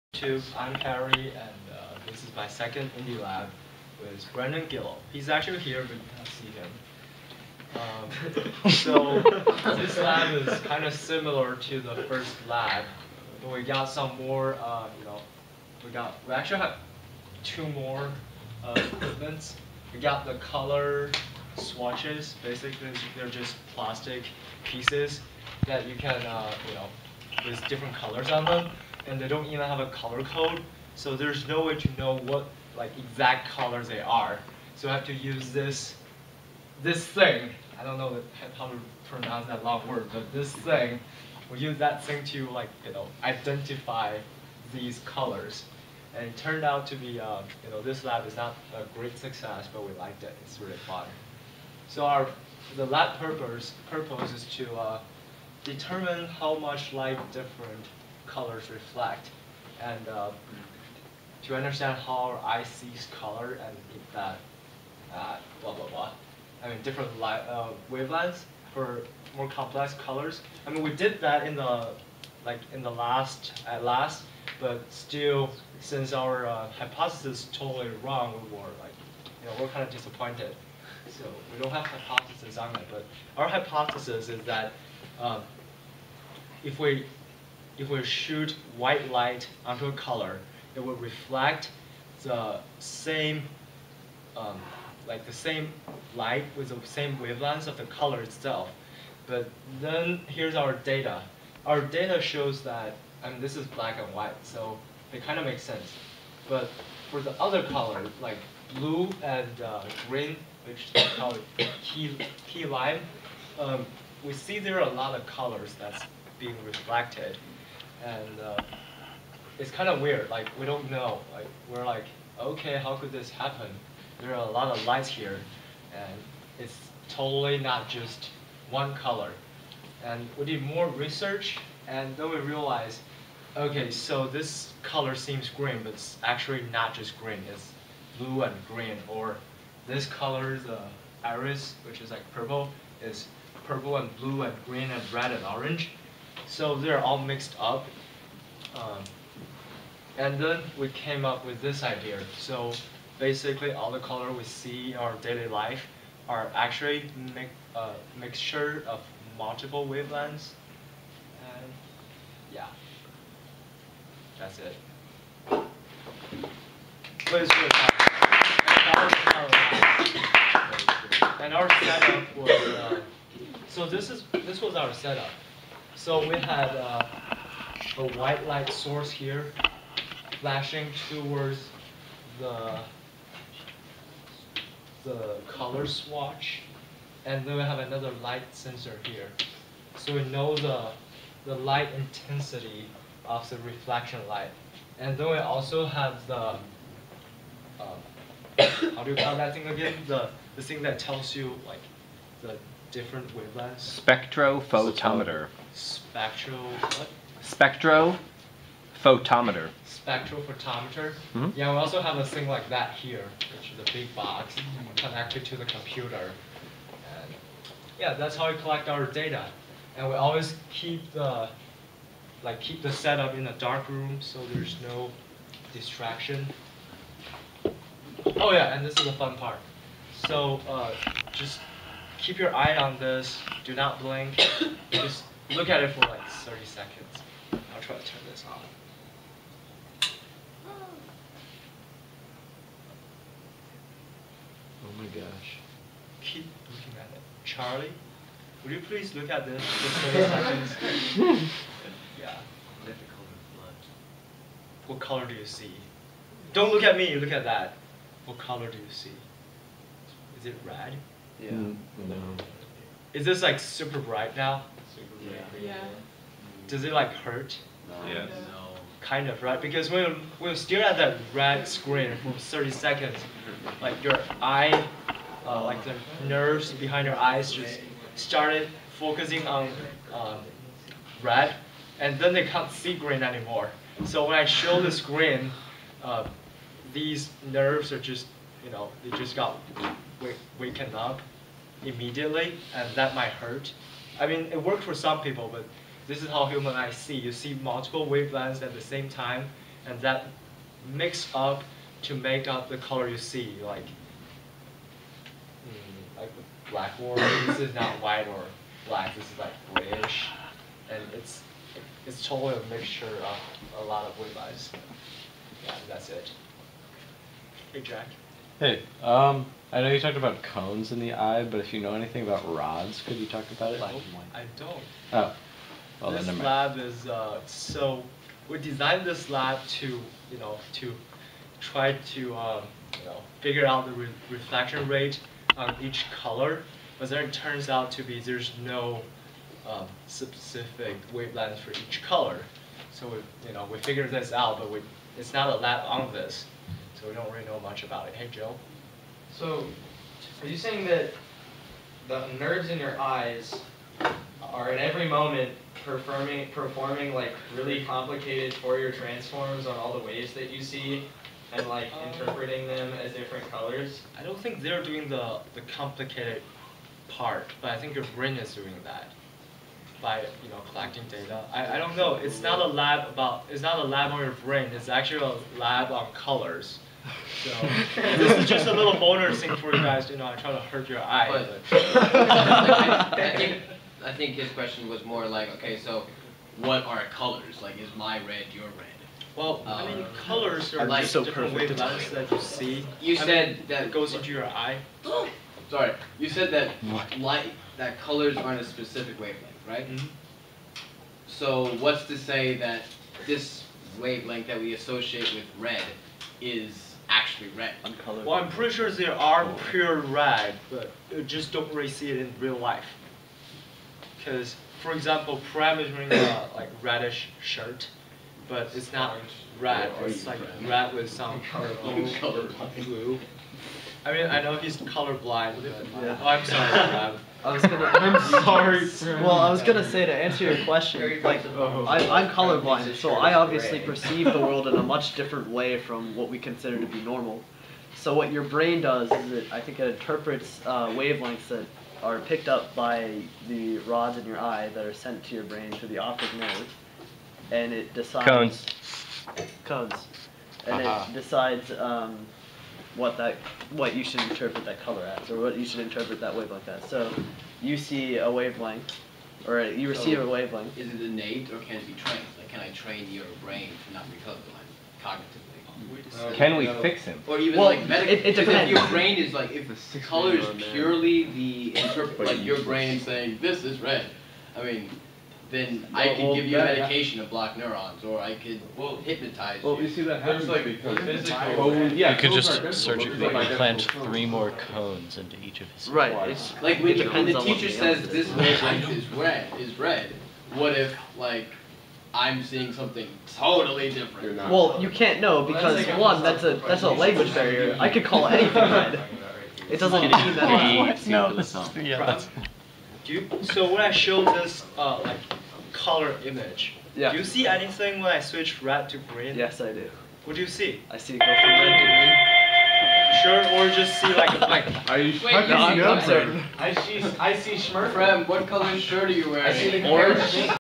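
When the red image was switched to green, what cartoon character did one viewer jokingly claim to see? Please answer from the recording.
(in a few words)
Smurf.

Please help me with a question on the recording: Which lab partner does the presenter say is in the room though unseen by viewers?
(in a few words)
Brendan Gill.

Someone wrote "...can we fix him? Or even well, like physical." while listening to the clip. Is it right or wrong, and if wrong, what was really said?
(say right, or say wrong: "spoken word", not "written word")
wrong: "medical", not "physical".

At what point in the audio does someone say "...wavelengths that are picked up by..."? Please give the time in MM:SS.
07:20.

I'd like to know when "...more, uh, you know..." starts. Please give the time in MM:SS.
00:14.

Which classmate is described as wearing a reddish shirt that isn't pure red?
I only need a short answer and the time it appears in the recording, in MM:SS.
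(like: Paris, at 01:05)
Prem, at 06:55.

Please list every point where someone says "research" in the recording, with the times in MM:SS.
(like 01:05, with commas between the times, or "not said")
02:10.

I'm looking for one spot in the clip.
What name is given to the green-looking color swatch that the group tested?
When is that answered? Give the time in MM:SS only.
01:52.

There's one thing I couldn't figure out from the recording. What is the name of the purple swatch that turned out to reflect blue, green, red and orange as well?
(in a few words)
Iris.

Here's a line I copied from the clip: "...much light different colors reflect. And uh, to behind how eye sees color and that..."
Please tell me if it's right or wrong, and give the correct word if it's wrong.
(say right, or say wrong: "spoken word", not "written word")
wrong: "understand", not "behind".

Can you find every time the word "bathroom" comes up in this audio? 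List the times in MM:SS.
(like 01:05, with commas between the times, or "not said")
not said.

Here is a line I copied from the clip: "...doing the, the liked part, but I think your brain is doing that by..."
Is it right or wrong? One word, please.
wrong.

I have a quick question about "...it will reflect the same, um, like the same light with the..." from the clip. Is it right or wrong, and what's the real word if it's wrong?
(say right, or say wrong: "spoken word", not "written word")
right.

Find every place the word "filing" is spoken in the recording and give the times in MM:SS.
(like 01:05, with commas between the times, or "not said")
not said.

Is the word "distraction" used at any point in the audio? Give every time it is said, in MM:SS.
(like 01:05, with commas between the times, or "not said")
03:45.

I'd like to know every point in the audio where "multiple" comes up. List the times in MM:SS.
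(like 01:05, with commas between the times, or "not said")
02:39, 04:57.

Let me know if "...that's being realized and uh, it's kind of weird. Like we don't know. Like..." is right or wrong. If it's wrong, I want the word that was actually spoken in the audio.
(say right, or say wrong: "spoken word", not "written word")
wrong: "reflected", not "realized".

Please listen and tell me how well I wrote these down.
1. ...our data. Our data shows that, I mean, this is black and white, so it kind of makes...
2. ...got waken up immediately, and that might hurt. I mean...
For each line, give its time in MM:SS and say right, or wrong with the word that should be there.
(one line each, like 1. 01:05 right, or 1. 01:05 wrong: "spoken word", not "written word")
1. 01:40 right
2. 04:49 right.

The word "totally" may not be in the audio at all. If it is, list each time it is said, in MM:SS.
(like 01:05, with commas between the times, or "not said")
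01:17, 02:07, 05:12, 08:13.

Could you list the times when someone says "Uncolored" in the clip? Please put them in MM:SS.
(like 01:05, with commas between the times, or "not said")
06:47.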